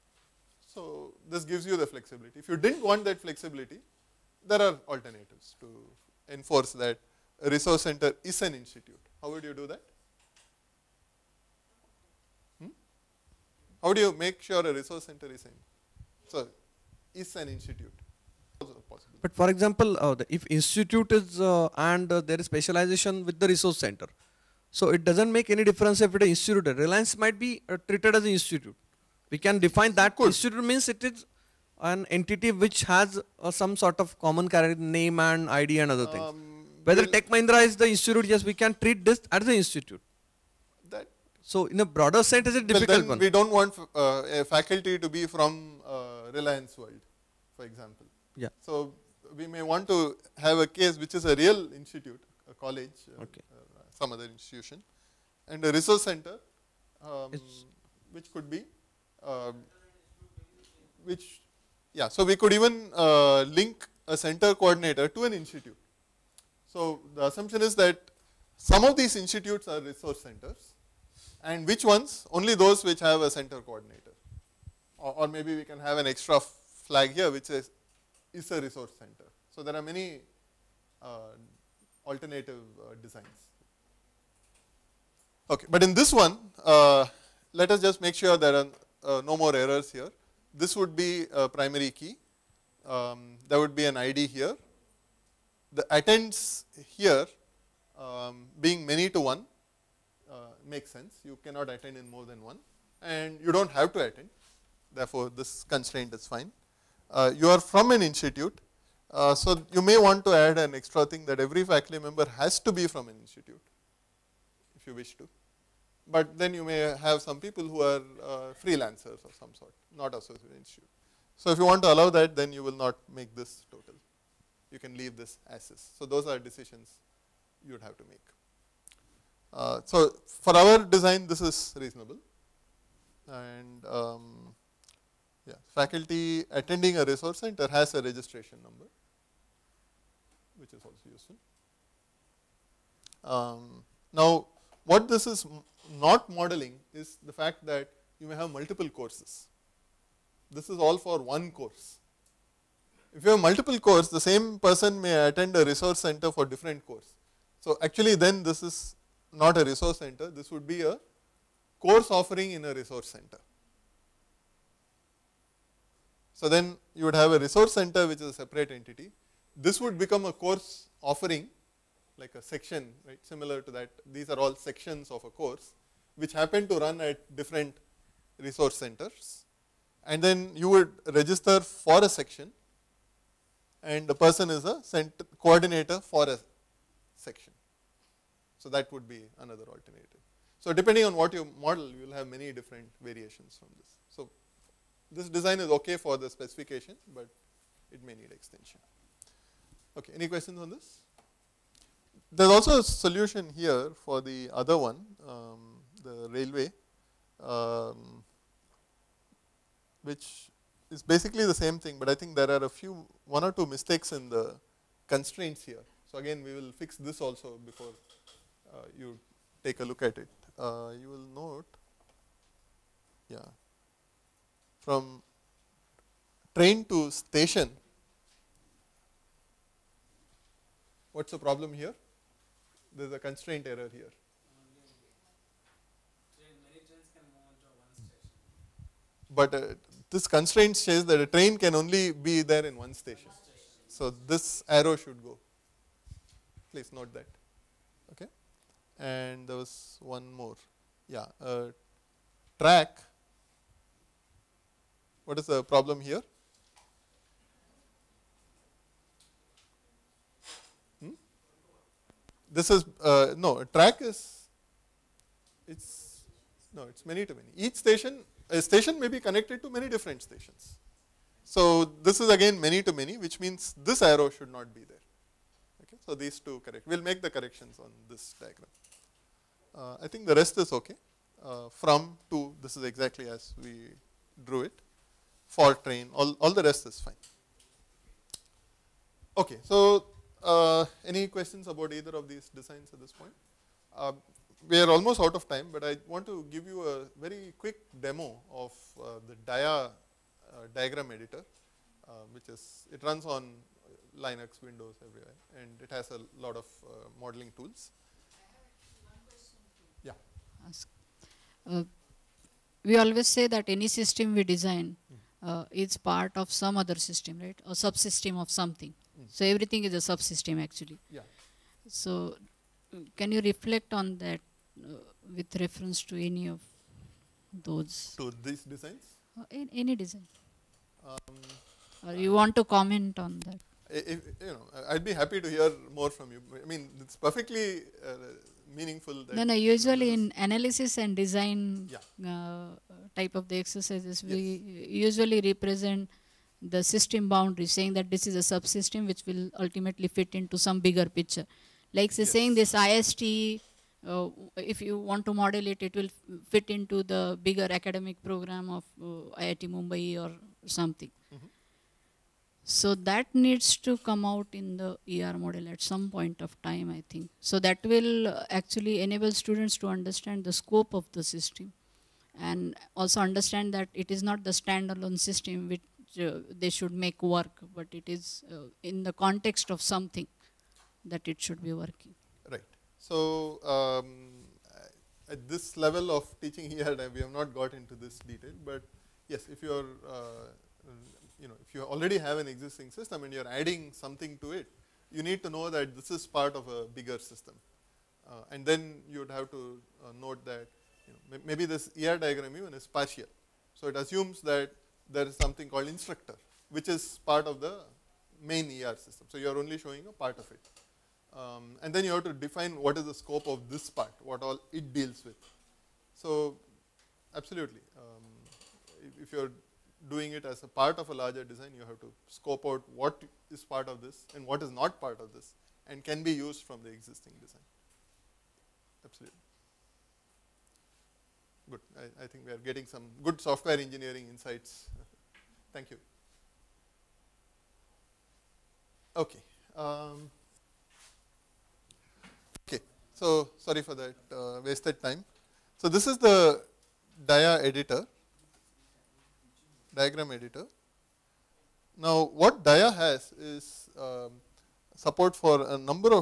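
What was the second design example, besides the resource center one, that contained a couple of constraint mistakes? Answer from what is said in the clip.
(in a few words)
railway.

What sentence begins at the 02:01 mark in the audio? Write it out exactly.
So if you want to allow that, then you will not make this total.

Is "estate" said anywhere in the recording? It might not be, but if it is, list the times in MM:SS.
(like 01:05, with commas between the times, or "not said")
not said.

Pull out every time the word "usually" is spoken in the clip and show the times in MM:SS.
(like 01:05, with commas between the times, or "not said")
05:39, 05:44.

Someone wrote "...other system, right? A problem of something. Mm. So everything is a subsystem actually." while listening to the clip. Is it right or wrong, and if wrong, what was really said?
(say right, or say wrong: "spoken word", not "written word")
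wrong: "subsystem", not "problem".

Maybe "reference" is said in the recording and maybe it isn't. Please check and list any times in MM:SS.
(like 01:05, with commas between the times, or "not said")
05:25.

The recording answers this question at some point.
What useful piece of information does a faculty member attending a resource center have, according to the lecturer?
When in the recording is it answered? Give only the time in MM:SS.
02:18.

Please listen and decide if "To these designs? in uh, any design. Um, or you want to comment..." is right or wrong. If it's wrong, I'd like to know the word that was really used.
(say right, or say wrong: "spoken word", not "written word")
right.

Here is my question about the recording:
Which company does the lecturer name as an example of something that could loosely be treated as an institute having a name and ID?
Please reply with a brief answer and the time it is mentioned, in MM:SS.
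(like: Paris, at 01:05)
Tech Mahindra, at 00:37.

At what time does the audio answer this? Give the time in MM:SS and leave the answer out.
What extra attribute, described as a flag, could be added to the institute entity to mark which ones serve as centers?
01:18.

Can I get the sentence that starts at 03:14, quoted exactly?
So this design is okay for the specification, but it may need extension.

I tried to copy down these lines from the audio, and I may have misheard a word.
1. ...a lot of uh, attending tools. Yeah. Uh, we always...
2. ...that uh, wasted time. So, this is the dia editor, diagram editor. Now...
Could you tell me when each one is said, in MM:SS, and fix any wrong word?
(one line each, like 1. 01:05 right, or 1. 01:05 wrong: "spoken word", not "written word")
1. 05:06 wrong: "modeling", not "attending"
2. 07:23 right.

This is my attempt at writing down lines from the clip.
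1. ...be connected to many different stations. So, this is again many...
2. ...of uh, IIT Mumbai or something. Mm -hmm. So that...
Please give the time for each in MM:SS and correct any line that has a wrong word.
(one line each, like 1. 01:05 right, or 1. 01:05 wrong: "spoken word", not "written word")
1. 04:29 right
2. 05:58 right.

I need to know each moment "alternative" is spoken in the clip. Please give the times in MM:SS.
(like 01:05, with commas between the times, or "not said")
00:04, 01:22, 03:09.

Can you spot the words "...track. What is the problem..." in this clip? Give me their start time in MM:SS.
04:12.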